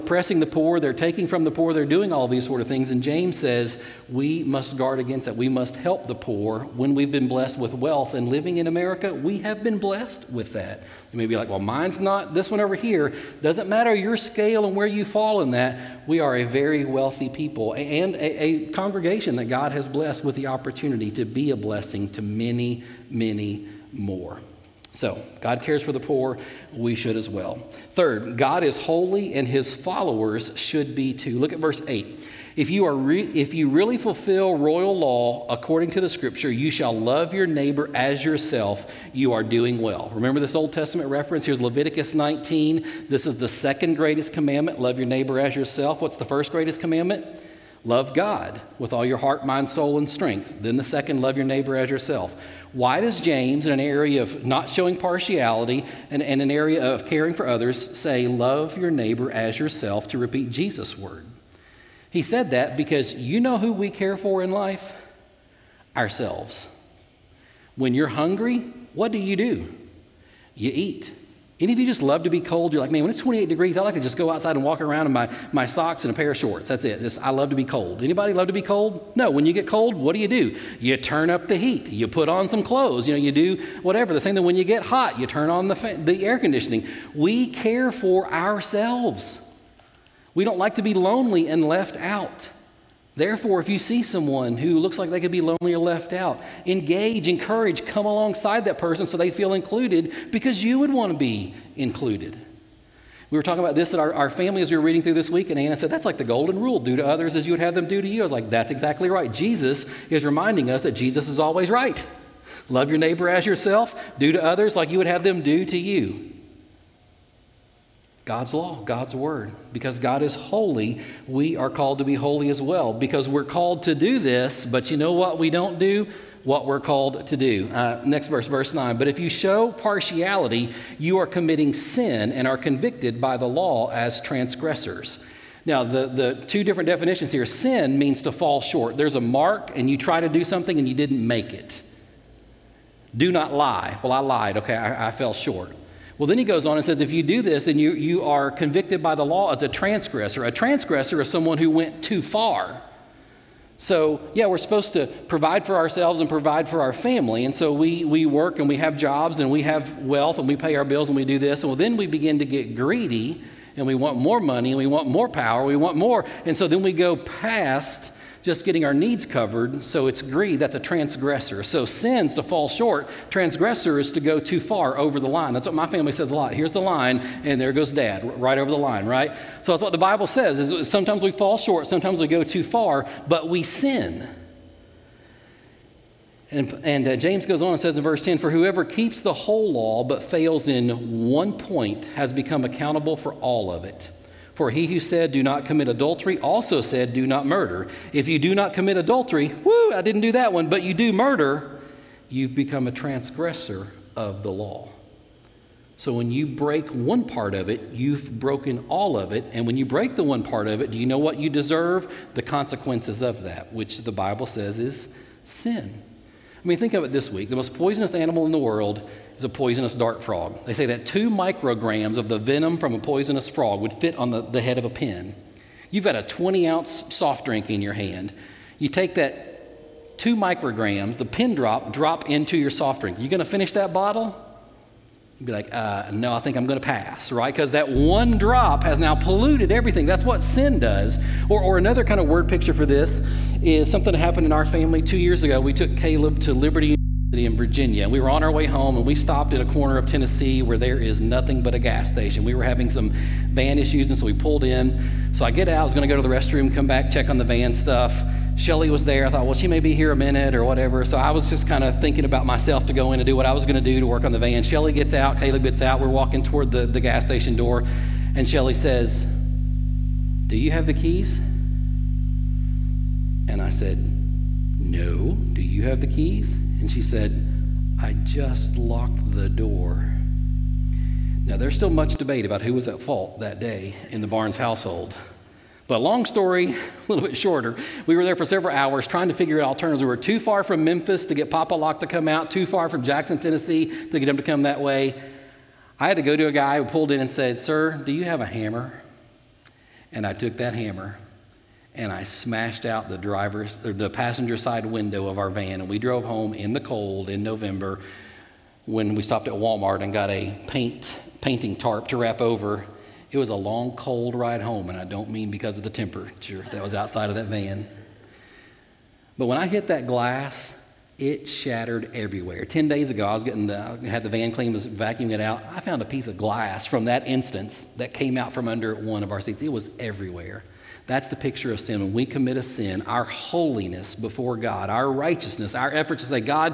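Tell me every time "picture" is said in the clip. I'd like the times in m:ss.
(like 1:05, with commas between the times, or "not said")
4:02, 5:31.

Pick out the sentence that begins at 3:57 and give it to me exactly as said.
Because that one drop has now polluted everything.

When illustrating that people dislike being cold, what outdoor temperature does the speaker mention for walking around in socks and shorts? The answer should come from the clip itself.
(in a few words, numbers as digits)
28 degrees.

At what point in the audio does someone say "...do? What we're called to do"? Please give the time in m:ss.
2:05.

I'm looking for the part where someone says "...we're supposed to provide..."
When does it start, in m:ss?
2:34.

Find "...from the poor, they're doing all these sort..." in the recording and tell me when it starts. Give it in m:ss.
0:01.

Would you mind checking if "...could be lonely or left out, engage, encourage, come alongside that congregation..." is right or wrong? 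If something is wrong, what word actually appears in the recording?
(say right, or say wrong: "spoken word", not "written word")
wrong: "person", not "congregation".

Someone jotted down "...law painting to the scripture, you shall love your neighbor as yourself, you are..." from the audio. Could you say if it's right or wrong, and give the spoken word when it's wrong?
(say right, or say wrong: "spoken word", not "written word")
wrong: "according", not "painting".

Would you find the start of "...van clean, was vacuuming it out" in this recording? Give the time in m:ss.
5:24.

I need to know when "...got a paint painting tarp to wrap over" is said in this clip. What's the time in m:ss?
5:10.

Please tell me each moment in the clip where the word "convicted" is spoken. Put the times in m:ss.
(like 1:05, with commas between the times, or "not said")
2:12, 2:28.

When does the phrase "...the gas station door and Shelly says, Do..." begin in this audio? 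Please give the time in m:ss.
4:26.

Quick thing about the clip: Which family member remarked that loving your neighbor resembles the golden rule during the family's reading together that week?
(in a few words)
Anna.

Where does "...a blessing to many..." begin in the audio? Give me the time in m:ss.
0:21.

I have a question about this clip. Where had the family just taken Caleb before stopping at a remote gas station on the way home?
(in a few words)
Liberty.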